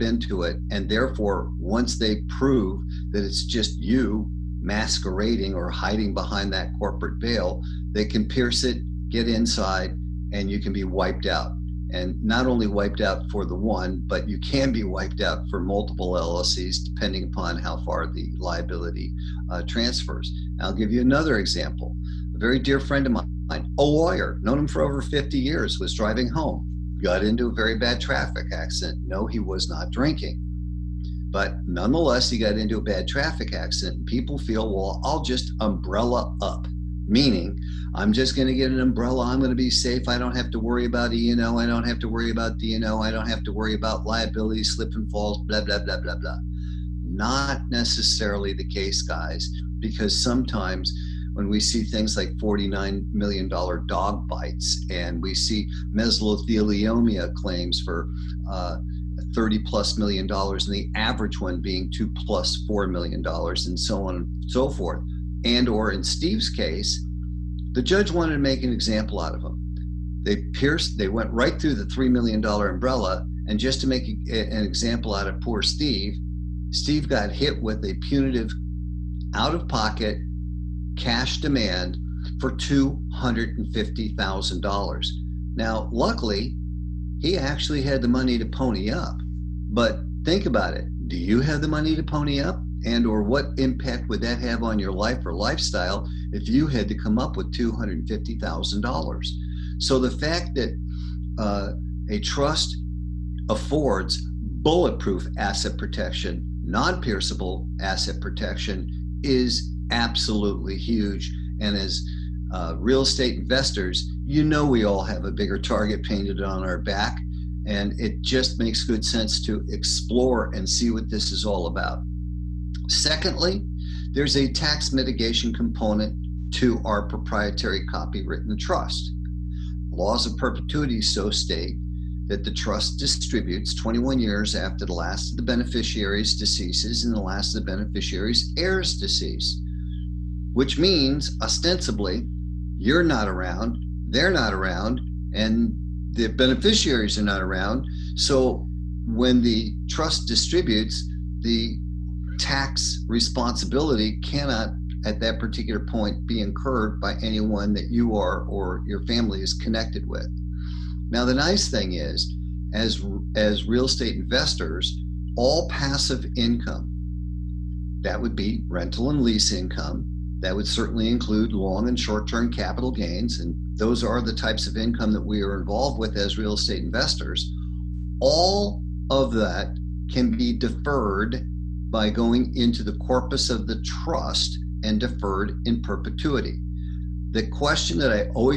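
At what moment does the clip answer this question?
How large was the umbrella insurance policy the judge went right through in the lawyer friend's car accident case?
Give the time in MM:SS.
01:11.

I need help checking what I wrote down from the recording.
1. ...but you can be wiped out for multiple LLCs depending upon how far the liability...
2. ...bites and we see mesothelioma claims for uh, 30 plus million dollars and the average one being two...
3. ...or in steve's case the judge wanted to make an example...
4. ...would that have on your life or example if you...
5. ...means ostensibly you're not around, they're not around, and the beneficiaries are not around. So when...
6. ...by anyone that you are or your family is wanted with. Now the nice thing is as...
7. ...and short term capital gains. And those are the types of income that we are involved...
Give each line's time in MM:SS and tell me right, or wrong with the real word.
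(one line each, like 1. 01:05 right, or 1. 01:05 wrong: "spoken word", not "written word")
1. 00:14 right
2. 00:54 right
3. 01:05 right
4. 01:34 wrong: "lifestyle", not "example"
5. 02:20 right
6. 02:37 wrong: "connected", not "wanted"
7. 02:51 right.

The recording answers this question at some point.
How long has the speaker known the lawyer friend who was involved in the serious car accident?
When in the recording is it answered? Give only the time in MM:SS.
00:24.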